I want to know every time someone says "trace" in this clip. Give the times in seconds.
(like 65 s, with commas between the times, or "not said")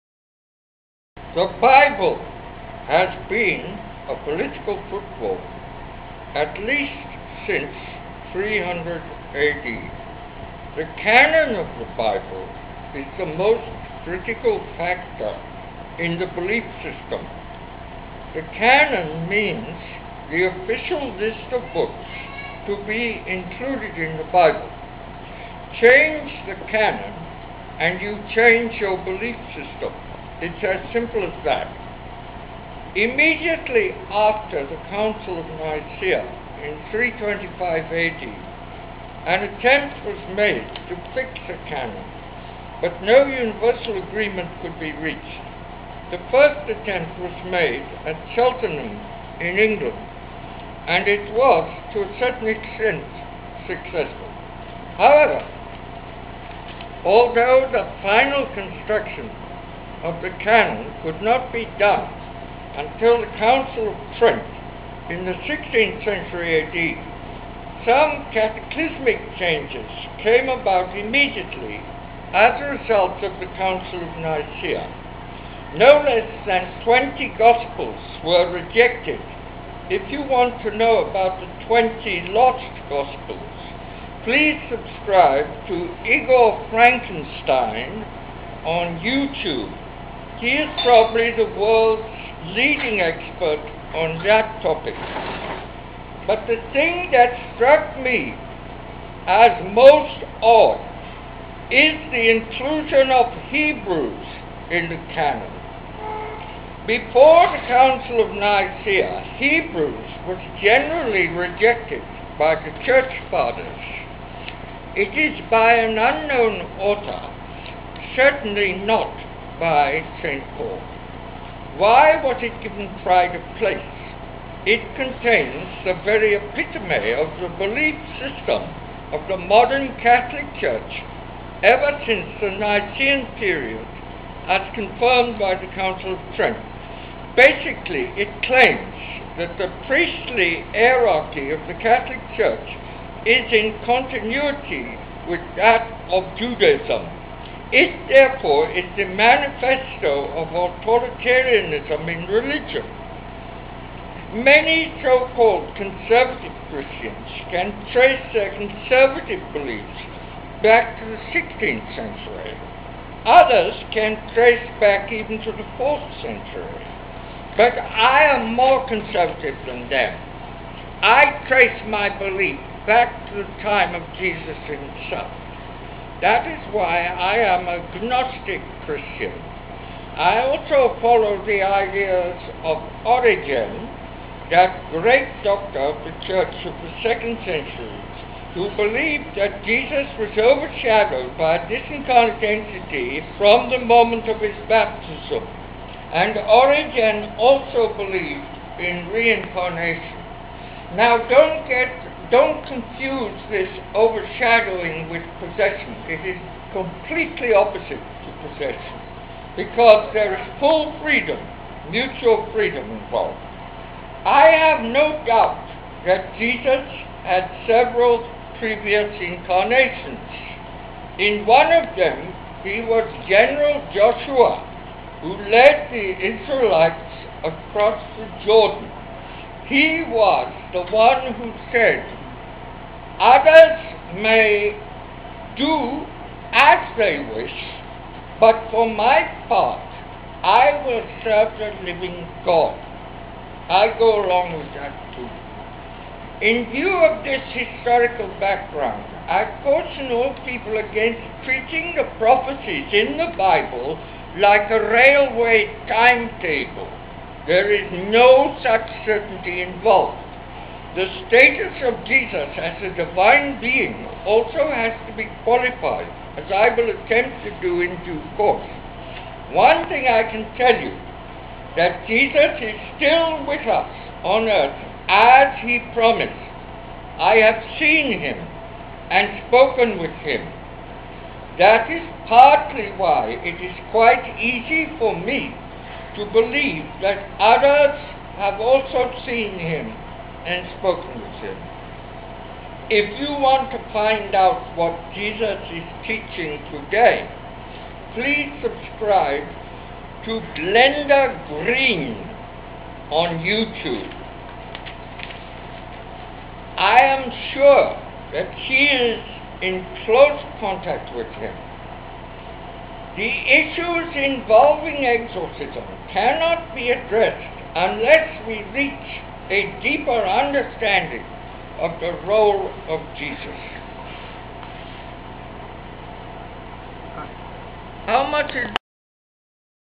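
157 s, 164 s, 171 s.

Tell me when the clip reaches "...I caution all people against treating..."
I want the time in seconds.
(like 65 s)
249 s.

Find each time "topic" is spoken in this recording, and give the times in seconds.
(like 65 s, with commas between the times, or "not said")
94 s.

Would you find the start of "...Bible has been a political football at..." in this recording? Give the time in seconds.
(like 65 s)
1 s.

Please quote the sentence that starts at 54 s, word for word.
However, although the final construction of the canon could not be done until the Council of Trent in the 16th century AD.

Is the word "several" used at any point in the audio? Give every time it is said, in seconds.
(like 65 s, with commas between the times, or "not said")
217 s.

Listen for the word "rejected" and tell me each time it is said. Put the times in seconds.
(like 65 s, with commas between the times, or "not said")
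78 s, 111 s.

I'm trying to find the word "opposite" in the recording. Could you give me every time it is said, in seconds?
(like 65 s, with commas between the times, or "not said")
207 s.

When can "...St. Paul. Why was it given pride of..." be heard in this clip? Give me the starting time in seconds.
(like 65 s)
120 s.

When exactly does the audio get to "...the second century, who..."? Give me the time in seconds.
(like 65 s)
186 s.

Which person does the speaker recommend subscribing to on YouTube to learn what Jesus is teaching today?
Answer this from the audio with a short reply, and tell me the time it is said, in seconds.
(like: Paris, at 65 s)
Glenda Green, at 300 s.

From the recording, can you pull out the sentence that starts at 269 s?
One thing I can tell you, that Jesus is still with us on earth as he promised.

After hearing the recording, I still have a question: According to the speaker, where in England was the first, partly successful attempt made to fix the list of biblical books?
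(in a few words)
Cheltenham.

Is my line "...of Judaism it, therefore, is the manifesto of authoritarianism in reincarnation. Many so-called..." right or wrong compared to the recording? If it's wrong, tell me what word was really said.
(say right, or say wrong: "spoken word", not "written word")
wrong: "religion", not "reincarnation".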